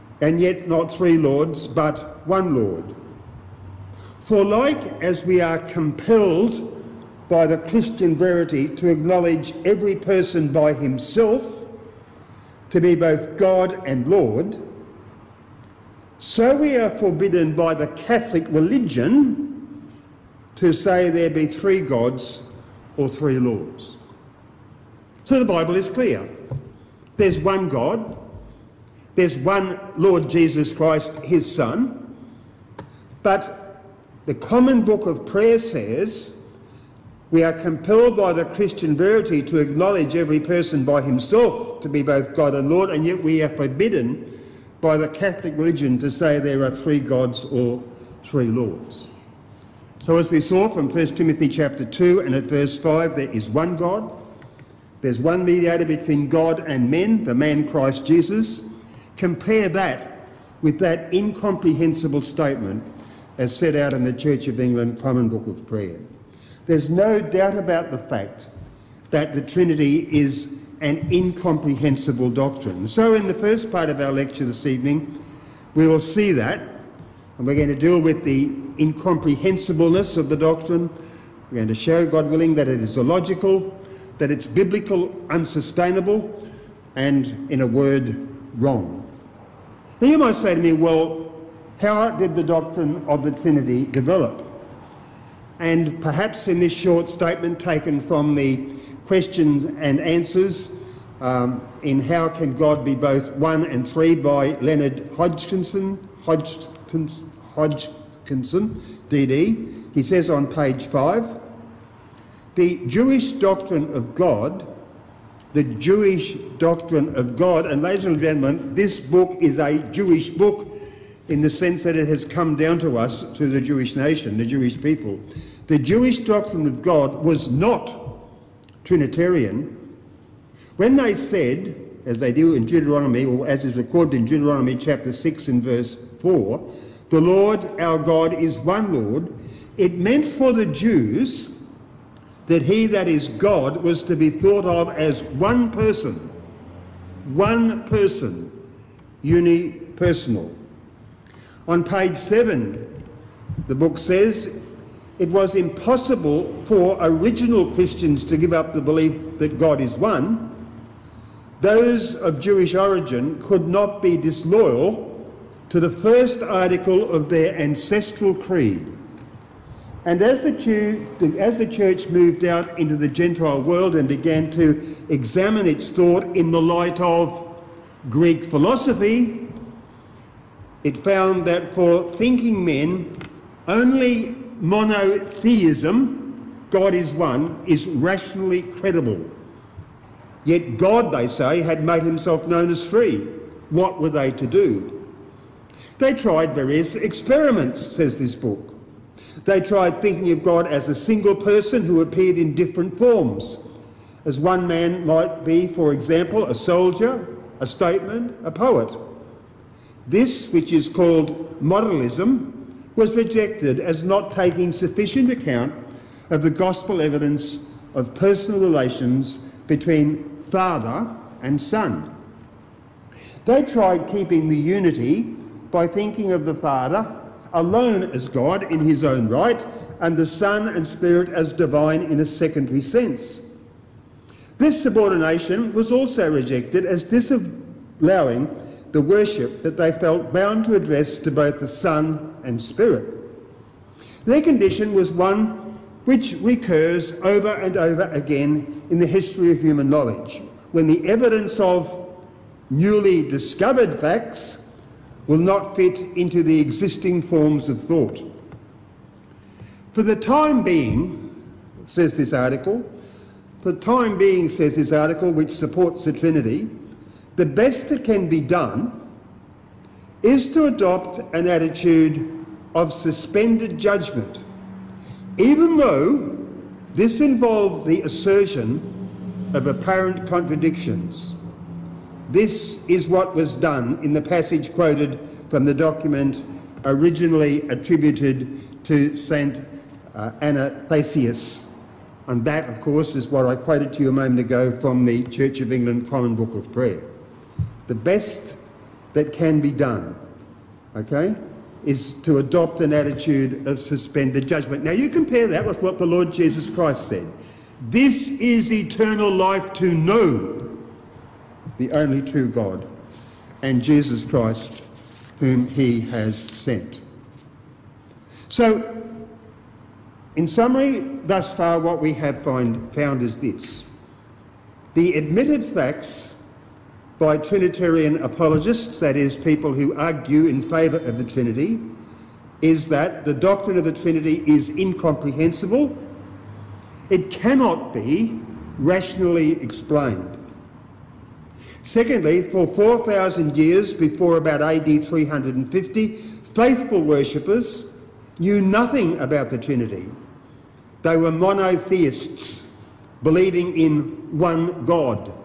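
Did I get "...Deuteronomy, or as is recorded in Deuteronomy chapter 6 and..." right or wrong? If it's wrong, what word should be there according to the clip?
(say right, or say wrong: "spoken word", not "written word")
right.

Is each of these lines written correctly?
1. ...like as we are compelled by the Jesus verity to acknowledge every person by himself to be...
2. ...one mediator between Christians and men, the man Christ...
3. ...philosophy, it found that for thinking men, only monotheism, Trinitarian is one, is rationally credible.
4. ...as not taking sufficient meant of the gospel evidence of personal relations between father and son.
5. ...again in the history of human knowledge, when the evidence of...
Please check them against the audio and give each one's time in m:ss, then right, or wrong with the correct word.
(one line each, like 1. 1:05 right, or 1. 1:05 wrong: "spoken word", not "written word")
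1. 0:04 wrong: "Christian", not "Jesus"
2. 0:55 wrong: "God", not "Christians"
3. 2:58 wrong: "God", not "Trinitarian"
4. 3:33 wrong: "account", not "meant"
5. 4:08 right.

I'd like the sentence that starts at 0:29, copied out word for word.
There's one Lord Jesus Christ, his Son.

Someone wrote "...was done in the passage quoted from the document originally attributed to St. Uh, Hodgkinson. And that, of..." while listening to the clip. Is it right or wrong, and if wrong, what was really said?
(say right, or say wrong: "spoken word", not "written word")
wrong: "Athanasius", not "Hodgkinson".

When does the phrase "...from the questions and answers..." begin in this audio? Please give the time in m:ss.
1:37.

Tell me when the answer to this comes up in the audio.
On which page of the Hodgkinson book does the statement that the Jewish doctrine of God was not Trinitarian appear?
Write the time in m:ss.
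1:50.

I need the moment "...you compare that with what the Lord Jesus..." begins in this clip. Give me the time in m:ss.
5:04.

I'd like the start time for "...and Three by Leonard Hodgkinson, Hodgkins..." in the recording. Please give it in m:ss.
1:43.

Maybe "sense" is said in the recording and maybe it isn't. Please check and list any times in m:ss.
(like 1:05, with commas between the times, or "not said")
2:01, 3:52.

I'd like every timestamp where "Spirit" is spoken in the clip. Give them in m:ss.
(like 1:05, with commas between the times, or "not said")
3:50, 4:02.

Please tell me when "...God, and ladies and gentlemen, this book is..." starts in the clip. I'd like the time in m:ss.
1:57.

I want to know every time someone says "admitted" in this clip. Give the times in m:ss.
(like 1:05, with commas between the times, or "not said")
5:25.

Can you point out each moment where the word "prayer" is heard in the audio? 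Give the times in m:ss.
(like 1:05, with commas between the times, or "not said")
0:35, 1:05, 4:56.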